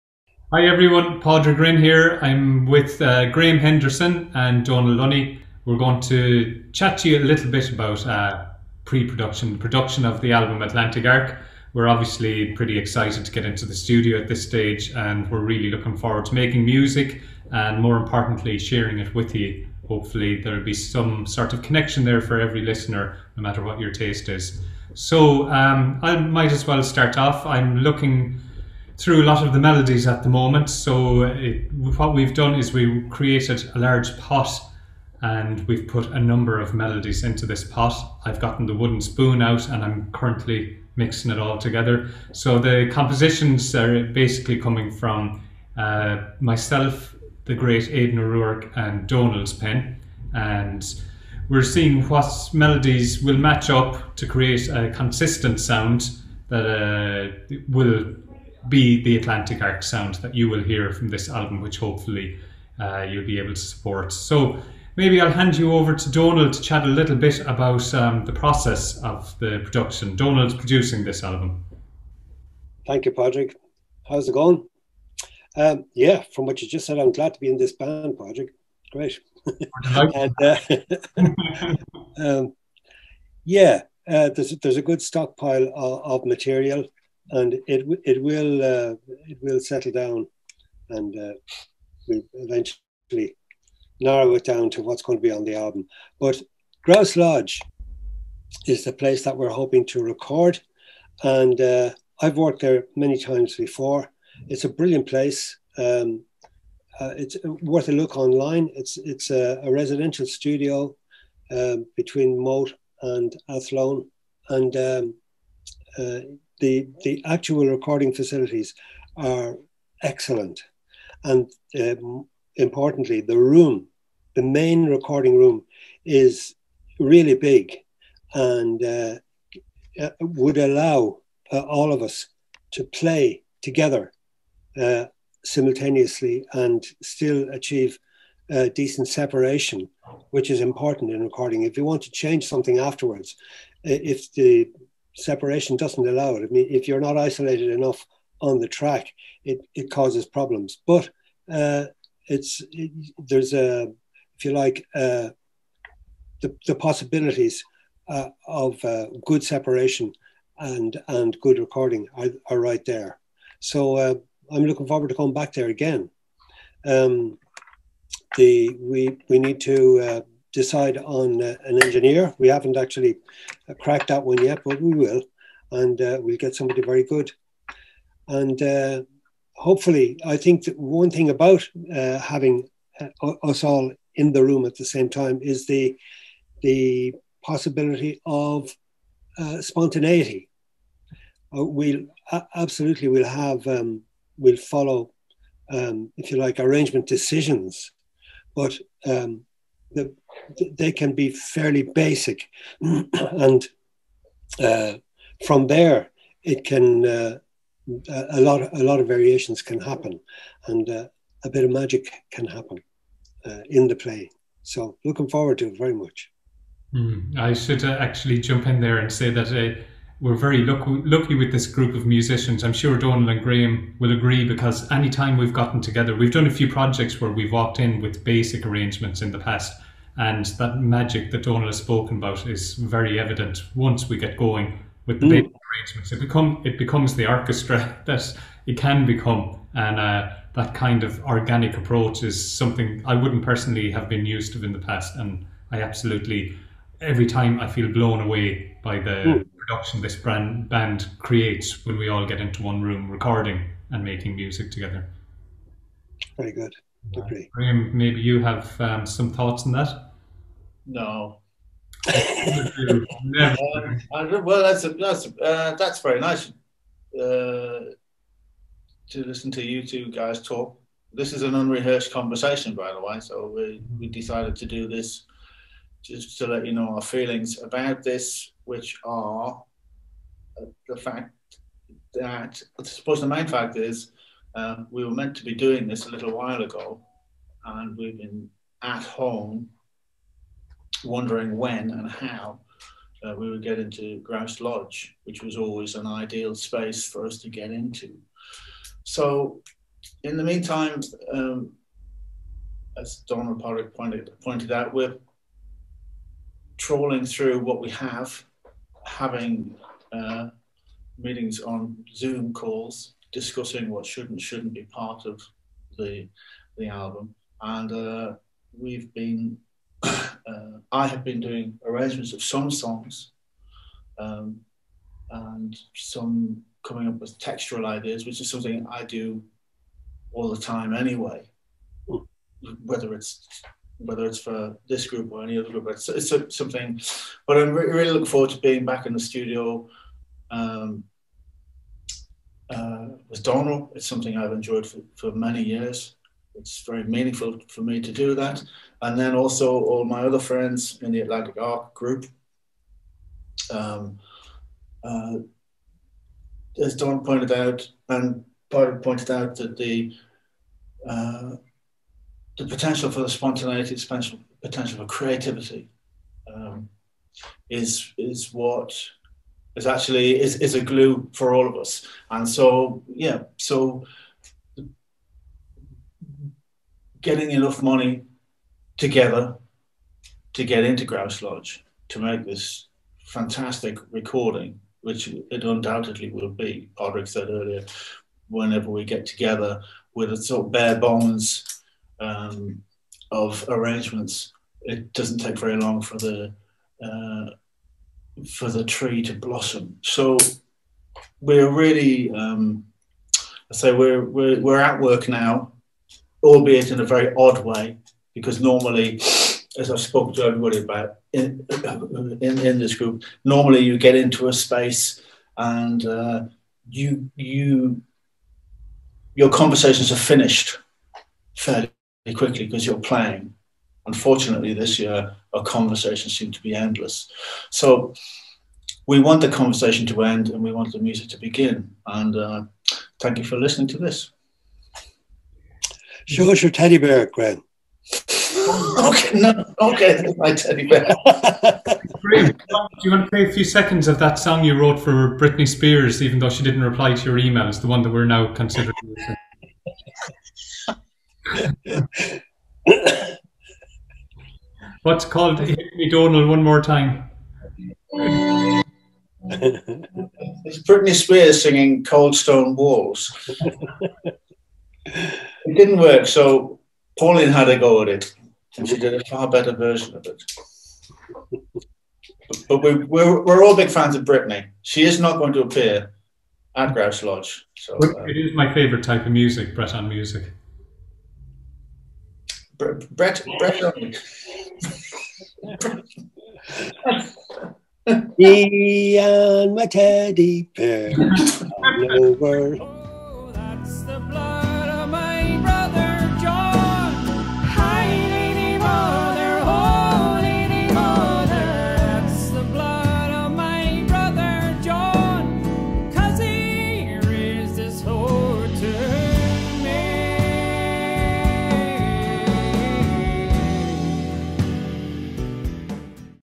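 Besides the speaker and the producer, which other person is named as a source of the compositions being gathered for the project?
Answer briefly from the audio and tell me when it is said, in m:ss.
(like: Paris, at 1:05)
Aidan O'Rourke, at 0:47.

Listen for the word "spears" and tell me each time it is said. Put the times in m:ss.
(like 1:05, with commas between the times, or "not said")
7:25, 7:41.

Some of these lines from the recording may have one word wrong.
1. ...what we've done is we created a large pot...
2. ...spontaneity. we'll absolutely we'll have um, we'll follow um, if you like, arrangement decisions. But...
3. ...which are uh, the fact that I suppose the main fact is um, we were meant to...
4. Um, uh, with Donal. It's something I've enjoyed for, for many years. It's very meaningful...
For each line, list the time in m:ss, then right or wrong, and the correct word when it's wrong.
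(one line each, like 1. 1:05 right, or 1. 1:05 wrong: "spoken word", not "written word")
1. 0:31 right
2. 3:09 right
3. 4:38 right
4. 5:40 right.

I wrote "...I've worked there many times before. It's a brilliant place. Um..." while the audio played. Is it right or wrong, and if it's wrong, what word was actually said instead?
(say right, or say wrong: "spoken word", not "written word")
right.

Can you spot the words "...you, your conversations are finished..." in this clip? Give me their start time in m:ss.
6:57.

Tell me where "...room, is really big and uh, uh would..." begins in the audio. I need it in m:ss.
2:05.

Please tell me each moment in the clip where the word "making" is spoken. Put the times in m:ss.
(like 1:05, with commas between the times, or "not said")
0:16, 4:14.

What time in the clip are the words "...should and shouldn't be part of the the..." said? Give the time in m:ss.
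5:14.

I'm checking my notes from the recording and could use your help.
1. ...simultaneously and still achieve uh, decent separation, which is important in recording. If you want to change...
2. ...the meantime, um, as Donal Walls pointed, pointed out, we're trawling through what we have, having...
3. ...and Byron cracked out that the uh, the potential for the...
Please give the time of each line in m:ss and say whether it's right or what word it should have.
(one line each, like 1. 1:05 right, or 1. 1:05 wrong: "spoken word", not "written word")
1. 2:15 right
2. 5:00 wrong: "Padraig", not "Walls"
3. 5:58 wrong: "pointed", not "cracked".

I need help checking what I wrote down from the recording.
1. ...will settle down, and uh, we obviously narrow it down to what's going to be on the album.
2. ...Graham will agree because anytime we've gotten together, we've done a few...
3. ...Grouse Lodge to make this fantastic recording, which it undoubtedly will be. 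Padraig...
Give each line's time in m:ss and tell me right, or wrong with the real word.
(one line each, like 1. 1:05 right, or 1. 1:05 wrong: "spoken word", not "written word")
1. 1:29 wrong: "eventually", not "obviously"
2. 3:43 right
3. 6:21 right.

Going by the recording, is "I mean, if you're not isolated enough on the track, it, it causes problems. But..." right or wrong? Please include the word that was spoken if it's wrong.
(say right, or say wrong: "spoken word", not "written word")
right.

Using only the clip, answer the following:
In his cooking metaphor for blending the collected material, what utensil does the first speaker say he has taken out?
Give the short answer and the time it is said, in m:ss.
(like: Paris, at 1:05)
Wooden spoon, at 0:38.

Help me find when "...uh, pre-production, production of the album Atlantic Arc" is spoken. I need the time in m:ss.
0:08.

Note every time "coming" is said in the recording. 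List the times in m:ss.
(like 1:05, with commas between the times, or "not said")
0:44, 2:45, 5:26.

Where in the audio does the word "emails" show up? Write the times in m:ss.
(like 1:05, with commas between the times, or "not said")
7:27.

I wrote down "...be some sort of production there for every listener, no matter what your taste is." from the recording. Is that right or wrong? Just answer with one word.
wrong.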